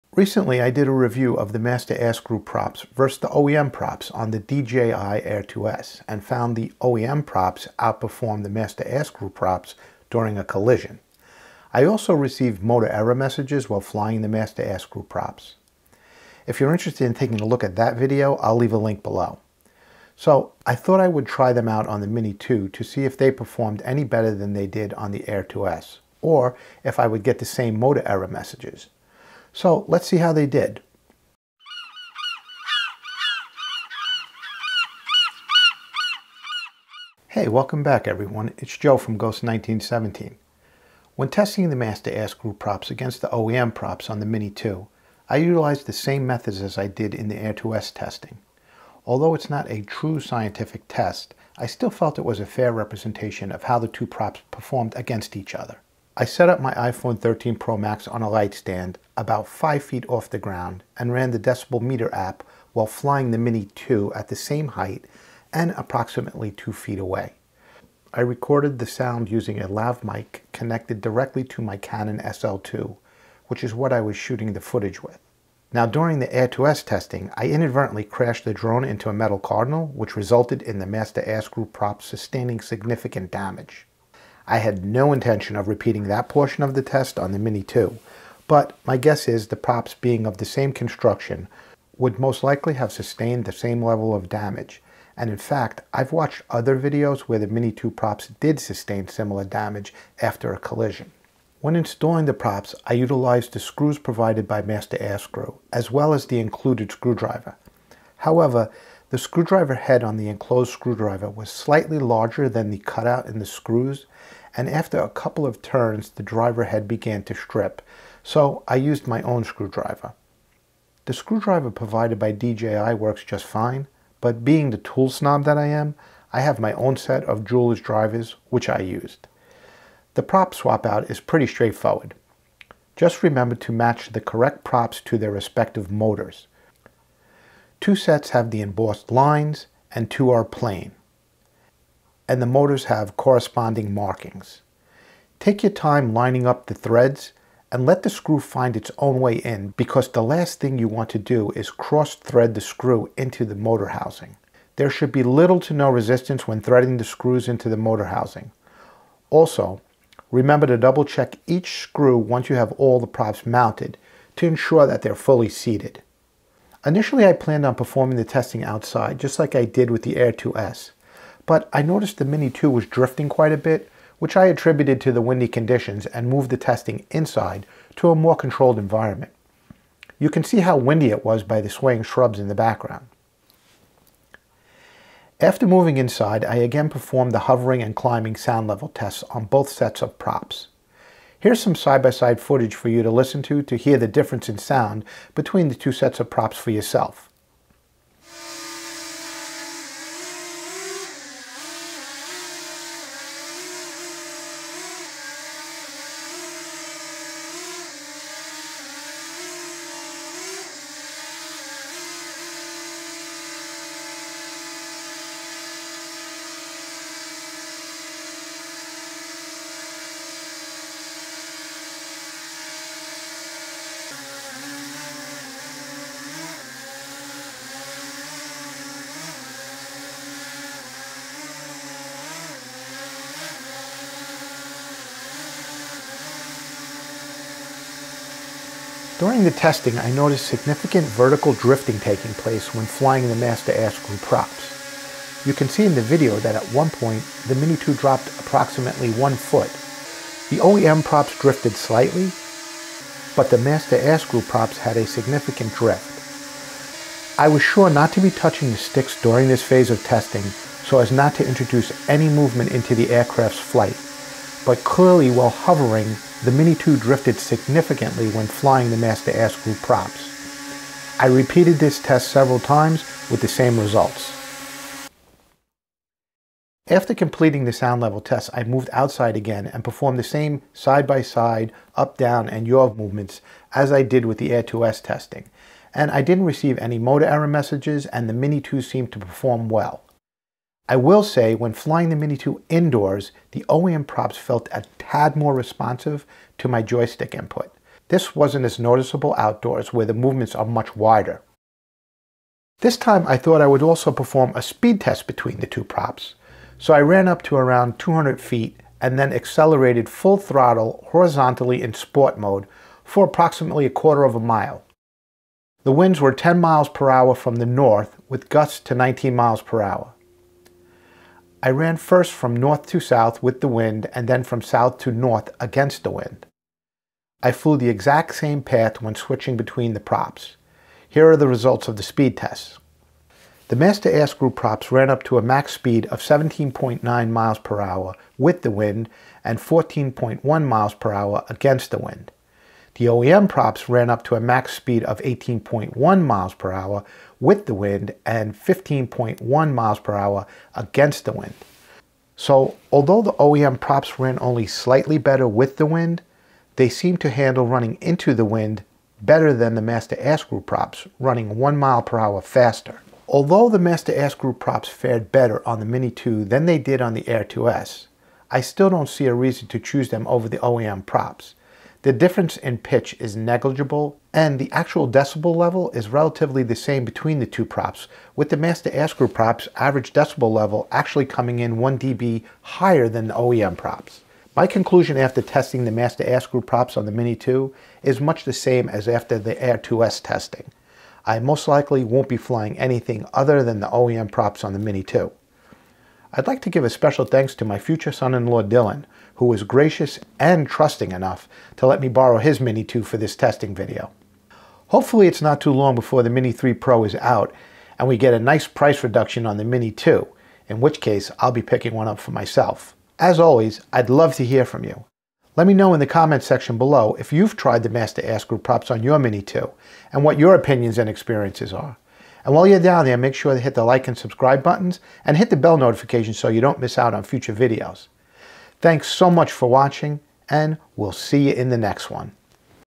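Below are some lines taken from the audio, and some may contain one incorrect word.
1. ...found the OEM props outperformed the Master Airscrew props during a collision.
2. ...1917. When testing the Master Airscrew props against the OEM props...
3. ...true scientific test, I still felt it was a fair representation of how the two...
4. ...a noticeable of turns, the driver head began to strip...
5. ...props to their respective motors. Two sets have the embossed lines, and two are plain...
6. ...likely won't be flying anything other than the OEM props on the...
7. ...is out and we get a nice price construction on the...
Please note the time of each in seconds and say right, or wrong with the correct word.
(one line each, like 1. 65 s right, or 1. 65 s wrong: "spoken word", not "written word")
1. 6 s right
2. 39 s right
3. 49 s right
4. 114 s wrong: "couple", not "noticeable"
5. 134 s right
6. 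391 s right
7. 407 s wrong: "reduction", not "construction".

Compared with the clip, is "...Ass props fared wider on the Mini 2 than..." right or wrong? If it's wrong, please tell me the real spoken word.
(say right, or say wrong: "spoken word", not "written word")
wrong: "better", not "wider".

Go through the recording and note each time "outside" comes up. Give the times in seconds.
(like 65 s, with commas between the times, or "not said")
168 s, 278 s.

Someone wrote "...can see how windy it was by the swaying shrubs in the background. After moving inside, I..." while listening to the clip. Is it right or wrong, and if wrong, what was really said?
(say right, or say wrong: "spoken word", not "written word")
right.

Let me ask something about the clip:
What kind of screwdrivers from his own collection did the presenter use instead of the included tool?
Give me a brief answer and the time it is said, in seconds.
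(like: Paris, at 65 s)
jeweler's drivers, at 127 s.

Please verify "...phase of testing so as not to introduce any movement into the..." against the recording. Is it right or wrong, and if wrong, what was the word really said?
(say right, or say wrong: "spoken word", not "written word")
right.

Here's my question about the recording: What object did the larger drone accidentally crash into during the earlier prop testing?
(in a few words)
metal cardinal.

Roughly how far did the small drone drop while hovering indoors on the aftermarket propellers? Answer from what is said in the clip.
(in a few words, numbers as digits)
1 foot.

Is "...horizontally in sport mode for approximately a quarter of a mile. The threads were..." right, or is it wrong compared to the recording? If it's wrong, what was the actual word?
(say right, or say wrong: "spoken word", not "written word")
wrong: "winds", not "threads".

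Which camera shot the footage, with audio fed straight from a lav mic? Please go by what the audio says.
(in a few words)
Canon SL2.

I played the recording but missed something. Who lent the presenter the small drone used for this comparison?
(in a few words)
Dylan.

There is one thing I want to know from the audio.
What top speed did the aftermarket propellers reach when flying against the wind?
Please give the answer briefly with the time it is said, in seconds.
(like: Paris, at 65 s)
14.1 mph, at 339 s.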